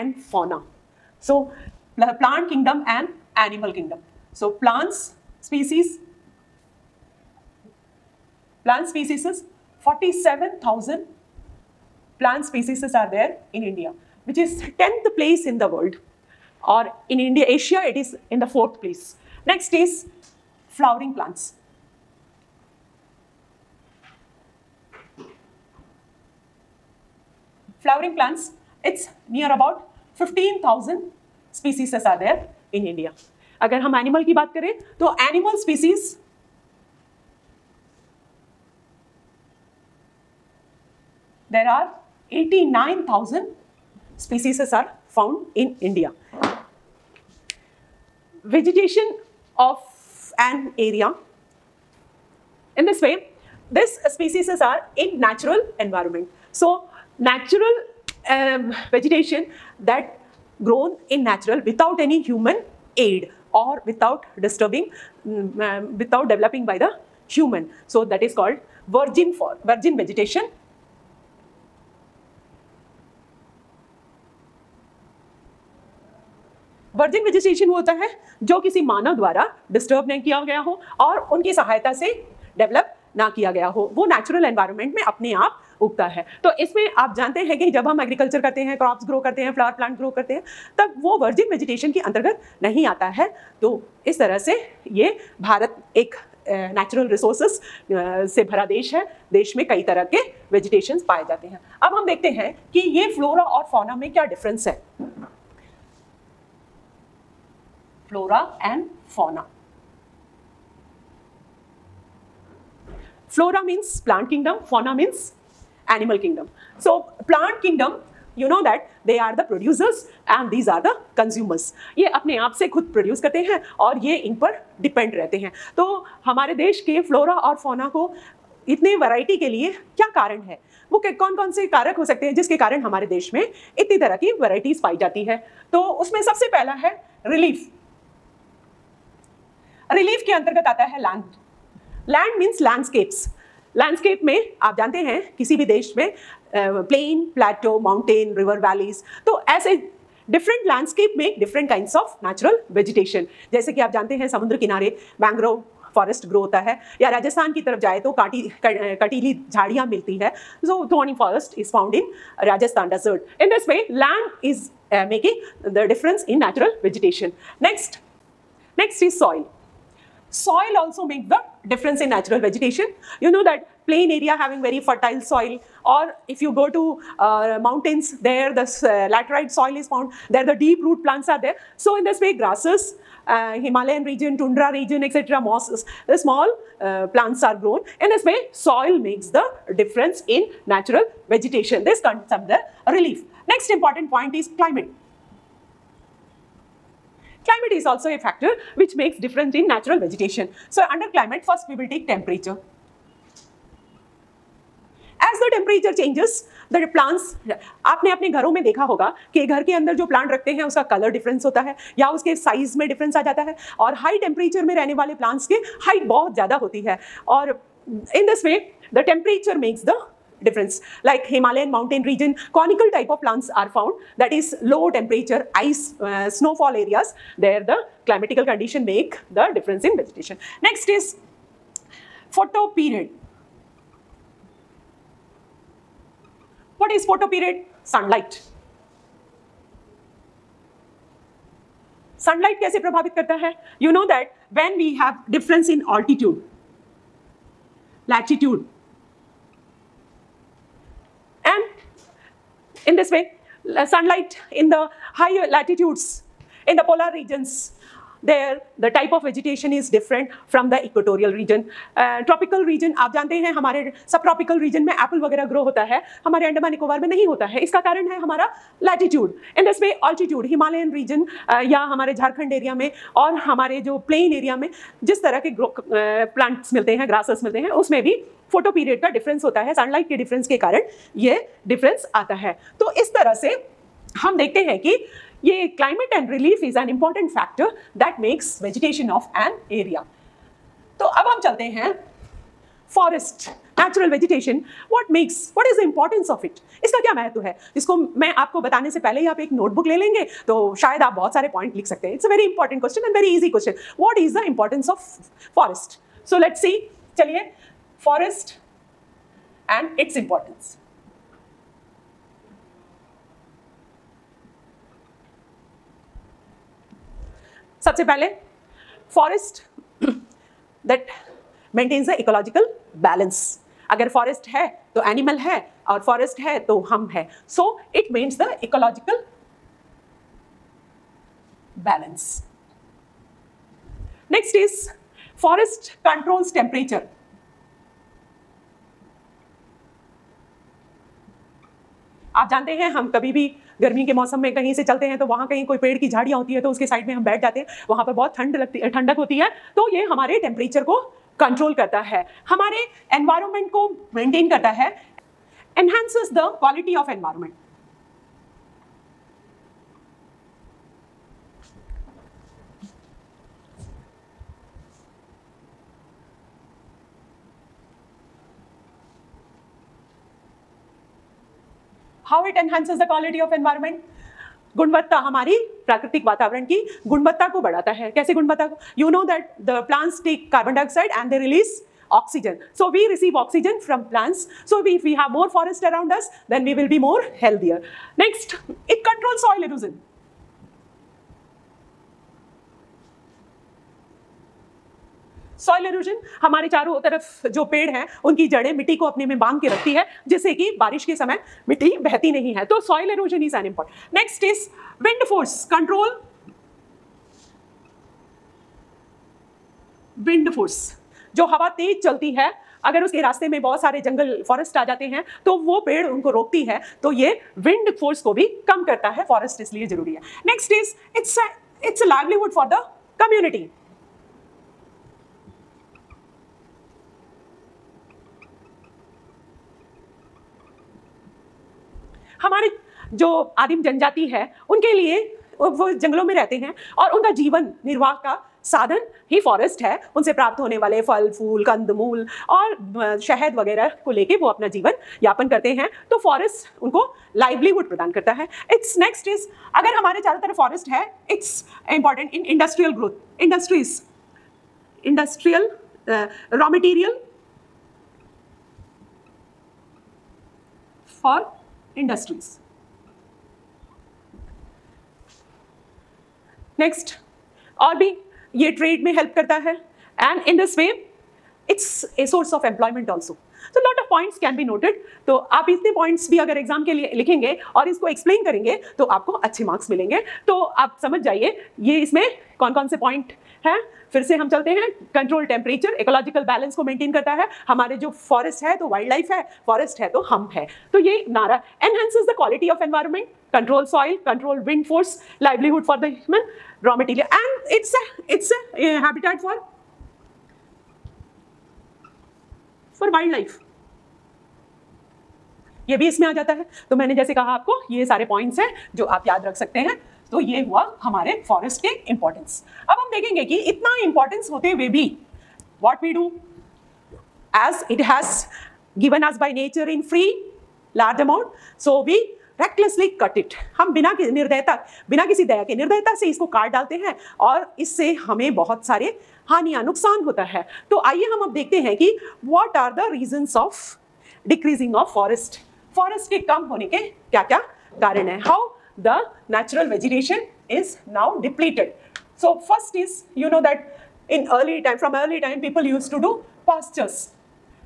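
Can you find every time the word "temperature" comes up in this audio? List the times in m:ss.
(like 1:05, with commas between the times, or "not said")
3:22, 3:44.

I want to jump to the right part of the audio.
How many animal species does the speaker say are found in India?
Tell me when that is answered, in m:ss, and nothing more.
0:42.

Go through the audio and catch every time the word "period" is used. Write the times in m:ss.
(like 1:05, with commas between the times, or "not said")
3:52, 3:57.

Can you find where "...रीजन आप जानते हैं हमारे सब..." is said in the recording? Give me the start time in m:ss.
4:22.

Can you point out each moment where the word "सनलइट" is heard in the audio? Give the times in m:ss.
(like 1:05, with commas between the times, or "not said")
4:02, 4:39.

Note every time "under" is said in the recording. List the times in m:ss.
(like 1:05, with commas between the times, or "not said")
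3:12, 3:20.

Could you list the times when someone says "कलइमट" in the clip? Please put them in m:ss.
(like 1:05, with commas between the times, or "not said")
4:45.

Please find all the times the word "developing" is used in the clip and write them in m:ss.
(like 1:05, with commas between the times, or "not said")
1:06.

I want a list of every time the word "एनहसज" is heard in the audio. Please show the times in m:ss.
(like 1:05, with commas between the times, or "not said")
6:12, 8:11.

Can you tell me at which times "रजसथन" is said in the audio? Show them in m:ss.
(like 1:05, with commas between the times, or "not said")
2:37, 2:42.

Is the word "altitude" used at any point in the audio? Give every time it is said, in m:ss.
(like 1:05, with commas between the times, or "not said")
4:05.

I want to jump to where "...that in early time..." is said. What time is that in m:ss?
9:03.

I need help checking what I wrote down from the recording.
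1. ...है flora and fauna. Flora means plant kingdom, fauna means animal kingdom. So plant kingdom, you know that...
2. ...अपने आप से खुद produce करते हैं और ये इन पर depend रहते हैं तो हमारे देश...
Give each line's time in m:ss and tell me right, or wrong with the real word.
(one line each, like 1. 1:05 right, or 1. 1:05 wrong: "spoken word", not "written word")
1. 1:44 right
2. 2:02 right.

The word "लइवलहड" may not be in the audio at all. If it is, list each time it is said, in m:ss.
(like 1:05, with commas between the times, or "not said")
7:02, 7:27.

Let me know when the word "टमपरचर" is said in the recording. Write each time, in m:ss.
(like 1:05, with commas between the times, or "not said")
3:25, 3:34, 3:39, 5:36, 5:50, 8:05.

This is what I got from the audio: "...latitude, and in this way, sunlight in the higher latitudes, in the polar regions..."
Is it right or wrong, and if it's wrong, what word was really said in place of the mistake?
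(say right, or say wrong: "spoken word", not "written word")
right.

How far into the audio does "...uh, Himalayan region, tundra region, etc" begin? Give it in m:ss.
3:03.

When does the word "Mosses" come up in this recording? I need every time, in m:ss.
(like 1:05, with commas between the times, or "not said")
3:05.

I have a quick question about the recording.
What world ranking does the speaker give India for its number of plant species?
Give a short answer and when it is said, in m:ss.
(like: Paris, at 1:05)
10th, at 0:14.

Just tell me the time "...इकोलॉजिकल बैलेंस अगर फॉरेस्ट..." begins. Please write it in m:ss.
5:22.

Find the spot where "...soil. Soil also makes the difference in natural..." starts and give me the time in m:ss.
2:49.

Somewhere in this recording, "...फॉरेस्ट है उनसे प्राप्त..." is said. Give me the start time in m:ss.
7:19.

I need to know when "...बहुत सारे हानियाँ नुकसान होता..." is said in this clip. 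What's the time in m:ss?
8:48.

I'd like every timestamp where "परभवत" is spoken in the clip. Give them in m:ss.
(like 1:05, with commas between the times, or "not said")
4:02.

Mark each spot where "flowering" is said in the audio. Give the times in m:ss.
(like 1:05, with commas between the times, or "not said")
0:20, 0:27.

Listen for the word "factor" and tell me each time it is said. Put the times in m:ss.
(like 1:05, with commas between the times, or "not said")
3:18.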